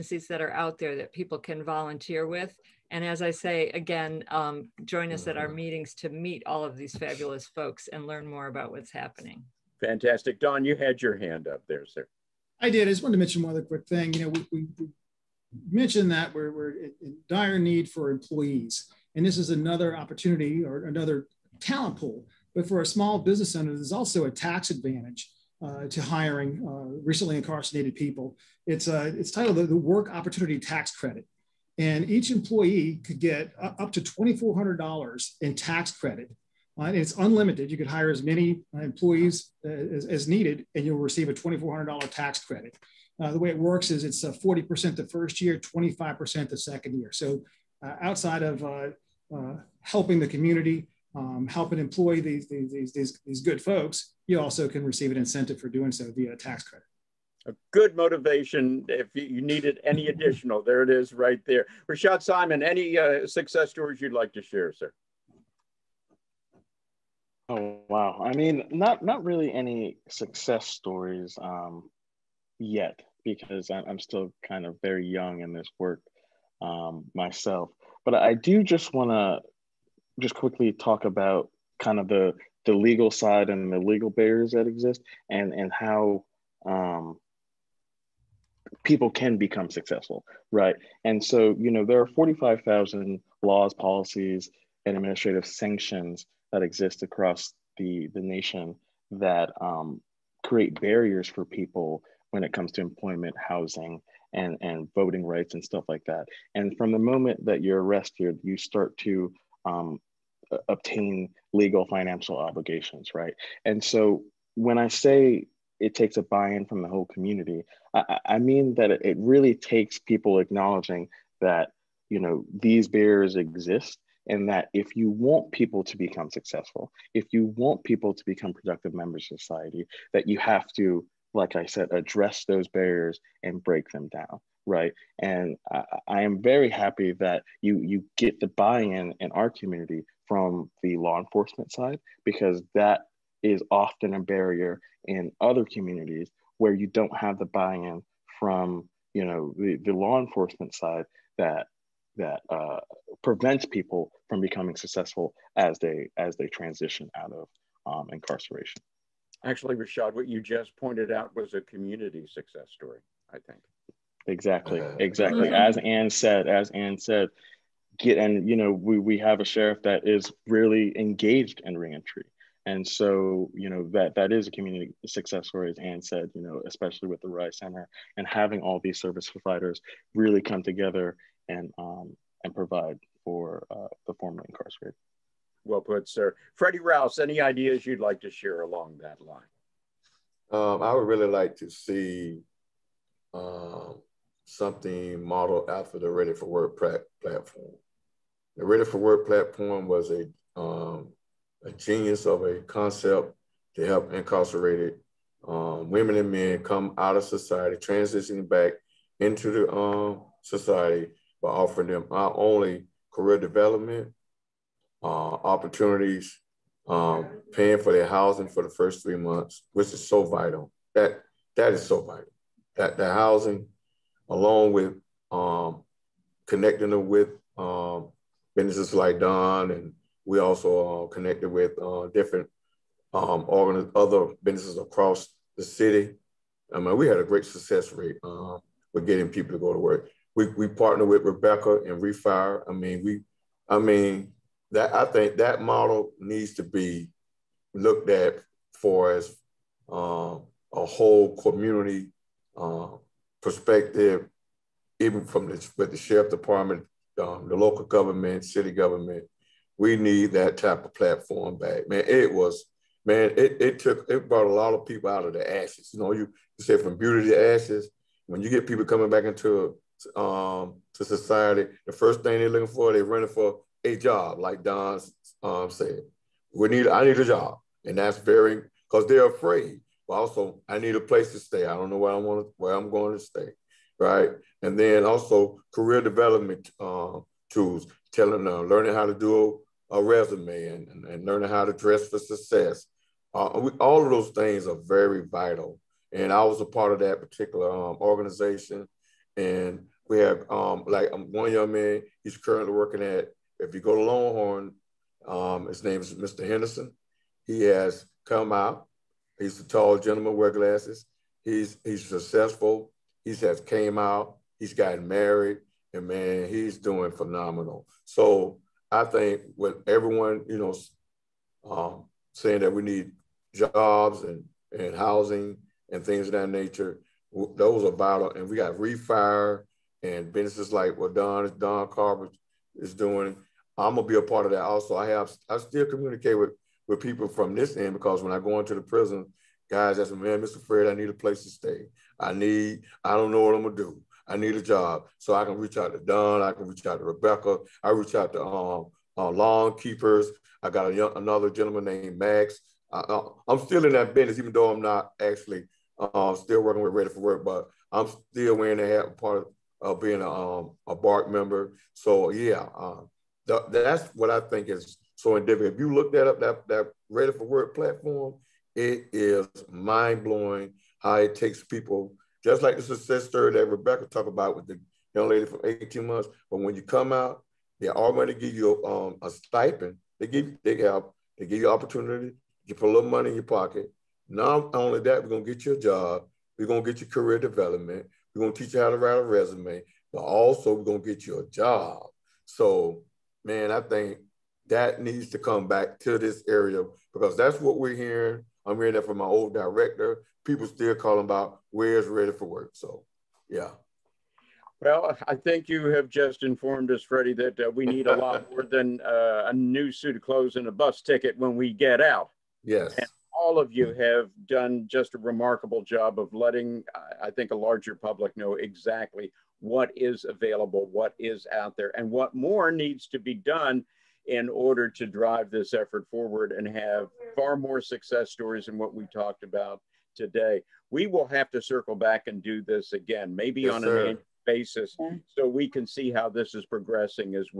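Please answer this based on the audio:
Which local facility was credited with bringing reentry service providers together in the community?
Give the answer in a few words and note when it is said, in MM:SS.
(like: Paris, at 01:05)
Rise Center, at 02:57.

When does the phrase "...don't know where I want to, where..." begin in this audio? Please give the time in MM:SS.
04:41.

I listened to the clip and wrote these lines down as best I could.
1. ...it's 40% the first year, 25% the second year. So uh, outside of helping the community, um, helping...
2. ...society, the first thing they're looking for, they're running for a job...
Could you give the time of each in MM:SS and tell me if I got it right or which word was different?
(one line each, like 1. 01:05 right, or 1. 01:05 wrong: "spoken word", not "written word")
1. 00:44 right
2. 04:31 right.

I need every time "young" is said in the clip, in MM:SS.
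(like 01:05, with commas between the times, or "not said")
01:15, 05:01, 05:50, 06:15.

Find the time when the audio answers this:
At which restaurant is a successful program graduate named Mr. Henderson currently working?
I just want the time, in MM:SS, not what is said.
05:04.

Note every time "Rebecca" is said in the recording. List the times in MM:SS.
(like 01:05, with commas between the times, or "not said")
04:01, 05:47, 06:13.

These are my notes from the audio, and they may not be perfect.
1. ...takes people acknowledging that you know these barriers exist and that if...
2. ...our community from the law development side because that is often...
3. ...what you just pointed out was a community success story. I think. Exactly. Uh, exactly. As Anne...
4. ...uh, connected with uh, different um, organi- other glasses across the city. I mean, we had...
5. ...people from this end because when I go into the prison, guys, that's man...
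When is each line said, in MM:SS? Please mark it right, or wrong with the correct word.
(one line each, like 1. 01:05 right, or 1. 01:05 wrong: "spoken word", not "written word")
1. 01:59 right
2. 02:19 wrong: "enforcement", not "development"
3. 02:40 right
4. 03:51 wrong: "businesses", not "glasses"
5. 05:37 right.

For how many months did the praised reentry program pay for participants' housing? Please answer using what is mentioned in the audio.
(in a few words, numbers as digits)
3.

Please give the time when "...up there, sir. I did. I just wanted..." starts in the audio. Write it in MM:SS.
00:11.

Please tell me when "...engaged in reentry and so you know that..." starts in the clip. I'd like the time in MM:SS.
02:50.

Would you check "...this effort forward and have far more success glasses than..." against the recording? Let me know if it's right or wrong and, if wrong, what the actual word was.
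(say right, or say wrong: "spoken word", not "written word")
wrong: "stories", not "glasses".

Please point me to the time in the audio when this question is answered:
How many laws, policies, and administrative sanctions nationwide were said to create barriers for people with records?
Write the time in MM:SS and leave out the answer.
01:32.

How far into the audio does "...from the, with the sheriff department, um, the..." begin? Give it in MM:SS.
04:15.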